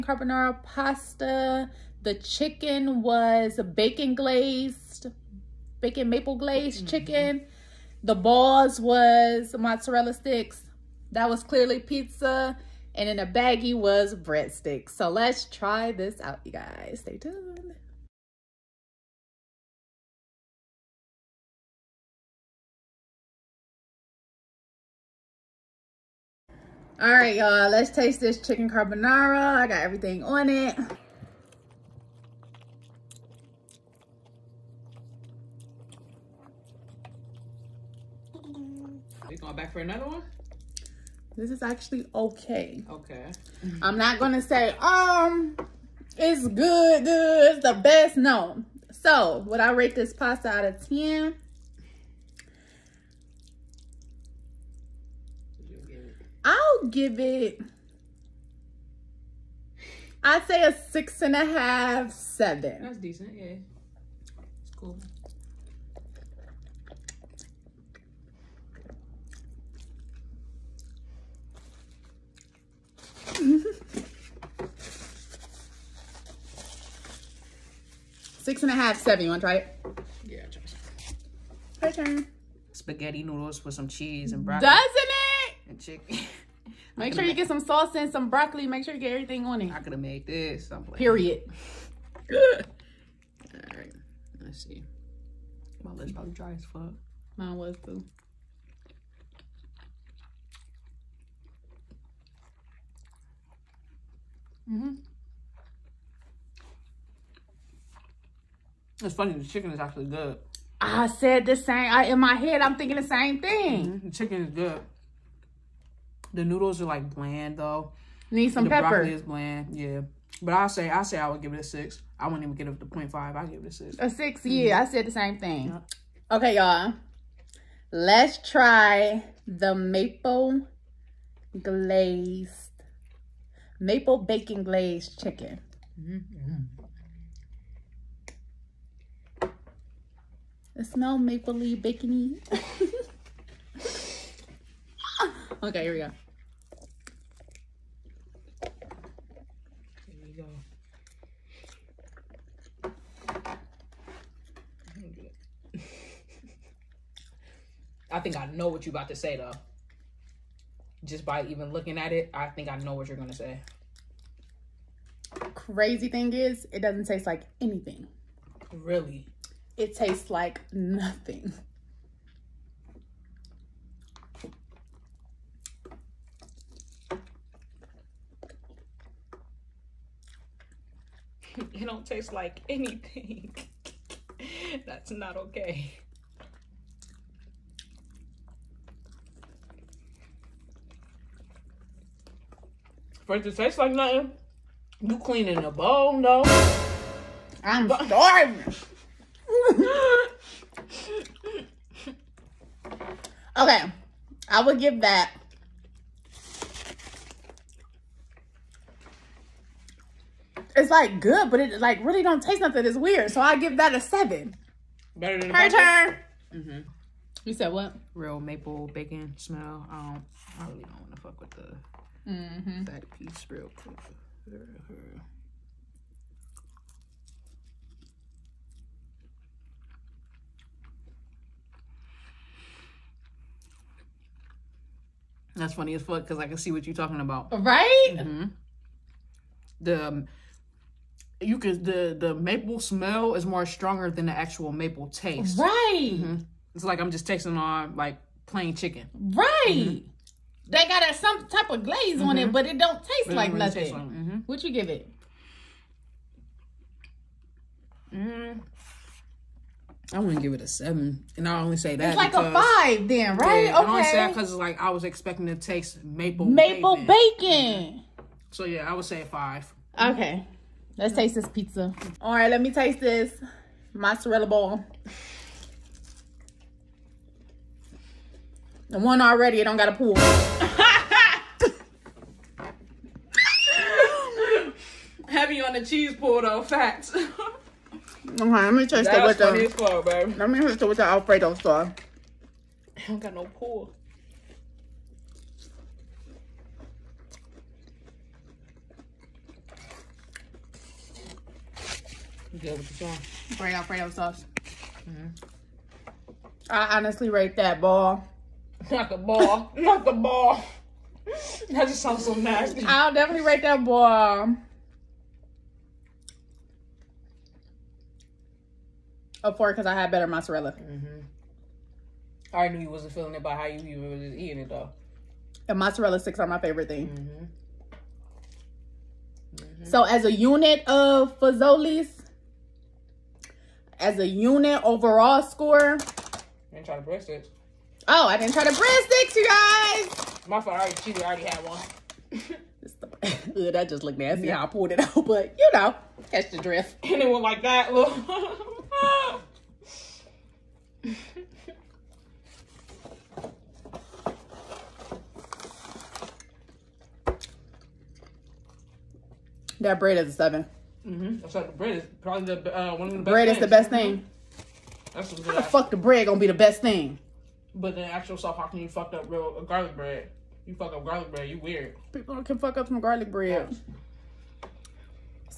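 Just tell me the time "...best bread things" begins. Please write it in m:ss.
6:03.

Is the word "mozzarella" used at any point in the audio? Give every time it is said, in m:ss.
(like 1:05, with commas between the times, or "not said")
0:09, 4:33, 5:20, 5:25.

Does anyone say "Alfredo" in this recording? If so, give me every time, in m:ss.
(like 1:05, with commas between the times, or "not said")
4:51, 5:03.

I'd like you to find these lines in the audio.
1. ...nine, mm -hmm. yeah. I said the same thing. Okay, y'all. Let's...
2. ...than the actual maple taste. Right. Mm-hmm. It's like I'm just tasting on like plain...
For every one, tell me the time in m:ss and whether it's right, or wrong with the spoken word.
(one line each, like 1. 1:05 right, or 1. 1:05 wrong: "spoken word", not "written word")
1. 2:04 wrong: "six", not "nine"
2. 4:04 right.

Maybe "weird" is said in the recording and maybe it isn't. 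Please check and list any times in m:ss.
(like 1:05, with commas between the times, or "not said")
3:32, 6:11.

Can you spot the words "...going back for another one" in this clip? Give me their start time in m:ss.
0:39.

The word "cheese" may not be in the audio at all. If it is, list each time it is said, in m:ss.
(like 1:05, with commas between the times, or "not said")
1:23, 4:45.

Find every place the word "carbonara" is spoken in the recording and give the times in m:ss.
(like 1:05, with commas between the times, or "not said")
0:00, 0:28.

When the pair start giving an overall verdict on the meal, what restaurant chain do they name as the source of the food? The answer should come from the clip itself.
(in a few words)
Fazoli's.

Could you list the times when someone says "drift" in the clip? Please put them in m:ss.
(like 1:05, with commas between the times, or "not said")
5:46.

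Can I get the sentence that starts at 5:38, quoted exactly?
Oh, I didn't try to breadsticks, you guys.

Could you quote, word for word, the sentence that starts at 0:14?
So let's try this out, you guys.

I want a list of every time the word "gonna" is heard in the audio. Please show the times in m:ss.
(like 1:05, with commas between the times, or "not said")
0:44, 2:43, 6:06.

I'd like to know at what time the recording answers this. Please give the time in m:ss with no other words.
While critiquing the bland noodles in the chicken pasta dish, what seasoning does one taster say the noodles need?
1:58.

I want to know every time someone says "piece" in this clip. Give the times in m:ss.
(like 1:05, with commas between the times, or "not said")
3:43.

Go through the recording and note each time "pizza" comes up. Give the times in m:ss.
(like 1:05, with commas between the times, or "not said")
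0:11, 4:31.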